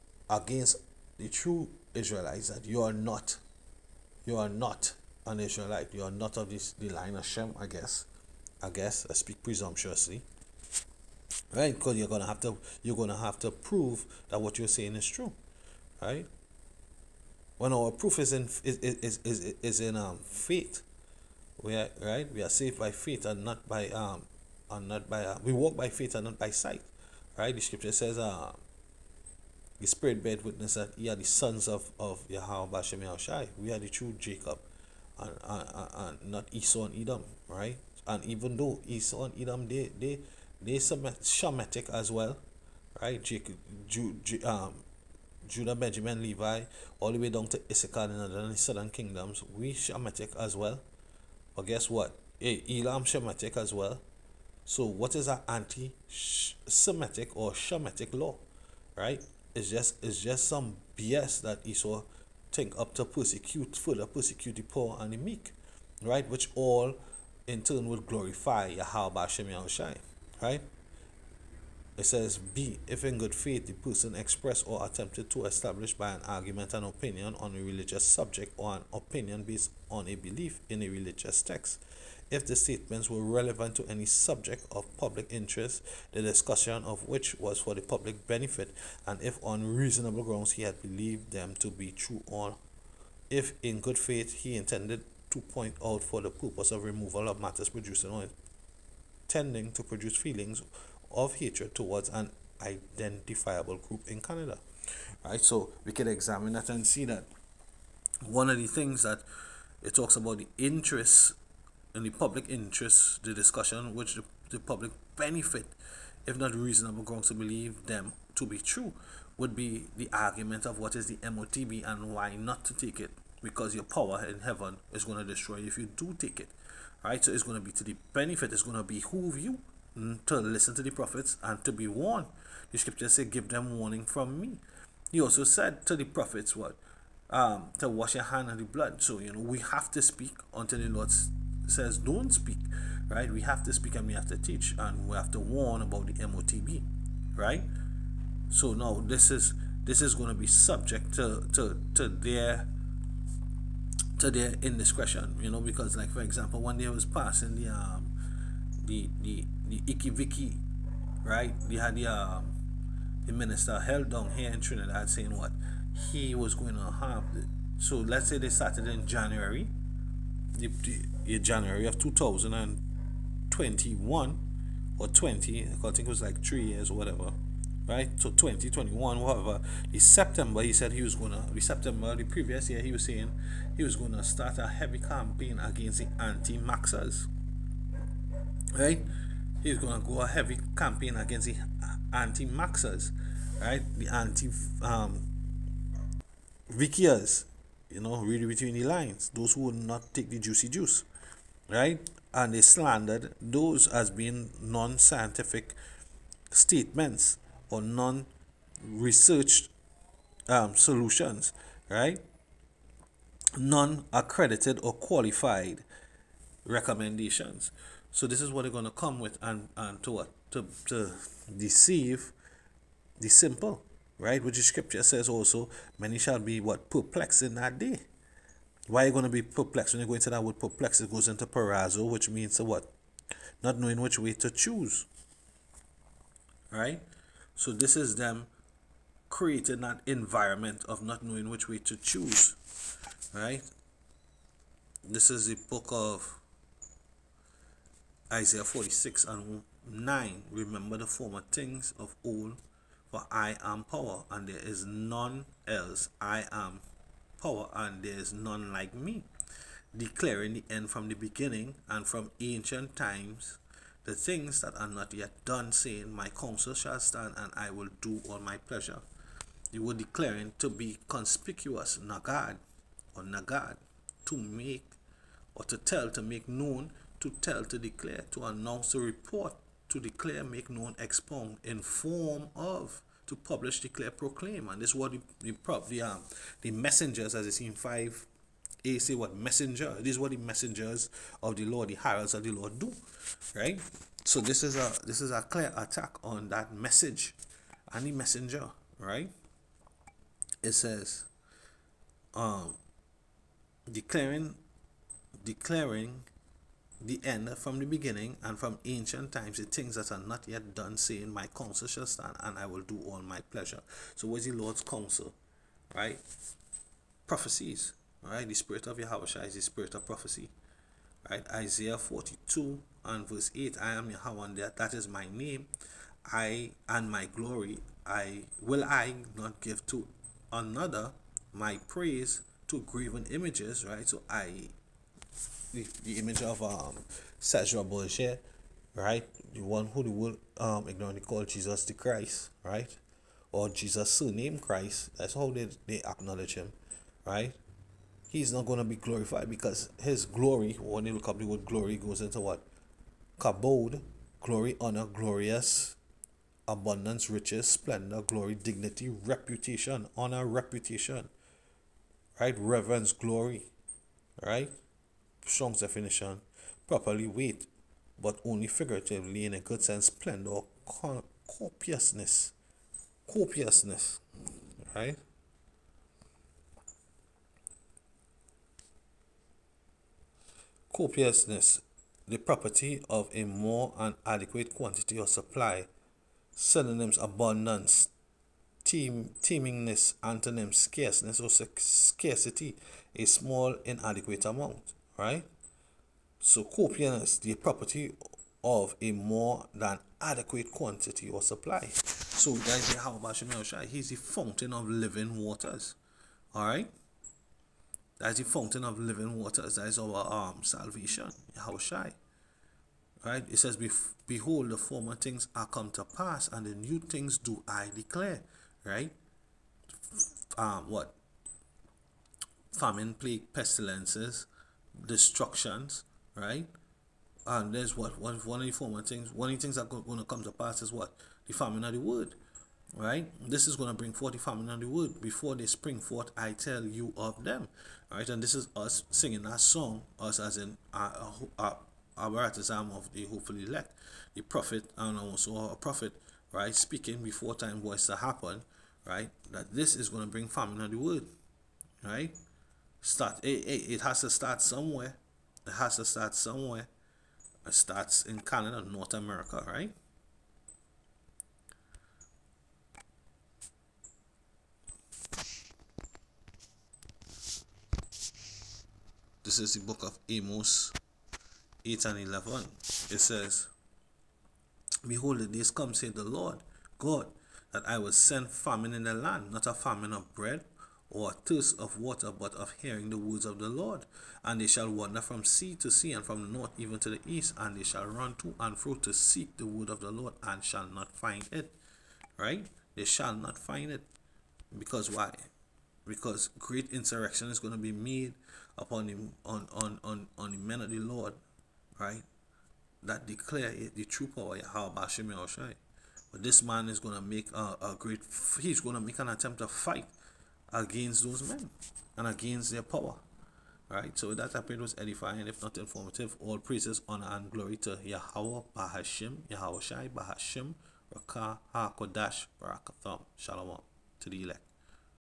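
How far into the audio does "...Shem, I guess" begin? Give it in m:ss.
0:07.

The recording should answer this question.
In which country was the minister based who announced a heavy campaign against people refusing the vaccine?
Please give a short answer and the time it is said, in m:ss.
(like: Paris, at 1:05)
Trinidad, at 2:44.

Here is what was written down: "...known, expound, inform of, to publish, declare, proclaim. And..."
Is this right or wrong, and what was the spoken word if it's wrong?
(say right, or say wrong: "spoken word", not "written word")
right.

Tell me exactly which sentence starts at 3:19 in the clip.
Those who would not take the juicy juice, right?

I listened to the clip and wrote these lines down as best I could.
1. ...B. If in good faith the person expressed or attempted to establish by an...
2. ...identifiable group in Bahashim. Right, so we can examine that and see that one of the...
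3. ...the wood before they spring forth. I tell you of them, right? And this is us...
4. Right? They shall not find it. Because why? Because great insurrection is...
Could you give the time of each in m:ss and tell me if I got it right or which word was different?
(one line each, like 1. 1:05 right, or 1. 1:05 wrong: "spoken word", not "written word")
1. 1:12 right
2. 1:42 wrong: "Canada", not "Bahashim"
3. 7:14 right
4. 8:12 right.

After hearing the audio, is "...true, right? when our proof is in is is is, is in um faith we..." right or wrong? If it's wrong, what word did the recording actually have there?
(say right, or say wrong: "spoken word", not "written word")
right.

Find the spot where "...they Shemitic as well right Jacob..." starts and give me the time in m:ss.
0:40.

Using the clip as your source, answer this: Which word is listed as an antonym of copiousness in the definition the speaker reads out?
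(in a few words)
scarceness.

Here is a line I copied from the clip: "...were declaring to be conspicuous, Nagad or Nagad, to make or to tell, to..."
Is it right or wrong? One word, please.
right.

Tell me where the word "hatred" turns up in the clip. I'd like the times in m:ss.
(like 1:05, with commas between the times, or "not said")
1:41.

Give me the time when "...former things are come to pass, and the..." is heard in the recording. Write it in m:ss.
6:54.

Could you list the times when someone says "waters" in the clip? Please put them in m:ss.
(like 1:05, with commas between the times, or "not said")
6:45, 6:49, 8:01.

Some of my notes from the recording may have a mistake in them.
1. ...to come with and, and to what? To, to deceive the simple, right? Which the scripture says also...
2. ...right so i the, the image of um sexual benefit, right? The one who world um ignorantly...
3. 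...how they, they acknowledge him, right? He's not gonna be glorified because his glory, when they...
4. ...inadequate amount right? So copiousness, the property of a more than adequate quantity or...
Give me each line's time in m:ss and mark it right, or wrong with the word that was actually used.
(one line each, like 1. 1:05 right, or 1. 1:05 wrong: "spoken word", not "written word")
1. 3:38 right
2. 5:33 wrong: "bullshit", not "benefit"
3. 5:45 right
4. 6:33 right.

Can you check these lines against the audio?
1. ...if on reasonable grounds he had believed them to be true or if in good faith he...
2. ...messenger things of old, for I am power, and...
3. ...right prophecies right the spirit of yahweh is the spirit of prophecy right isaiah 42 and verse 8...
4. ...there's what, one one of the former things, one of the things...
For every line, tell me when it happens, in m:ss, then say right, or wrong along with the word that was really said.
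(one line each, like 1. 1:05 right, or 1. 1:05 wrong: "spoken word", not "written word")
1. 1:29 right
2. 4:11 wrong: "former", not "messenger"
3. 5:15 right
4. 7:07 right.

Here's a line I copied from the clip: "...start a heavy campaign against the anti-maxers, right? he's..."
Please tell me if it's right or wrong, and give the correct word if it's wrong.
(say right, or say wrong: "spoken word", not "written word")
right.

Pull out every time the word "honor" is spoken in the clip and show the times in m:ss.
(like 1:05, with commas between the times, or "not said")
5:54, 6:00, 8:37.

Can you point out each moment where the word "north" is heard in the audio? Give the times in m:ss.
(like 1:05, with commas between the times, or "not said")
7:38, 8:06.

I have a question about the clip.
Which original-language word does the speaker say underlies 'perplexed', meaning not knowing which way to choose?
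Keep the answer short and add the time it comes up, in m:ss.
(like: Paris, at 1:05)
parazo, at 3:51.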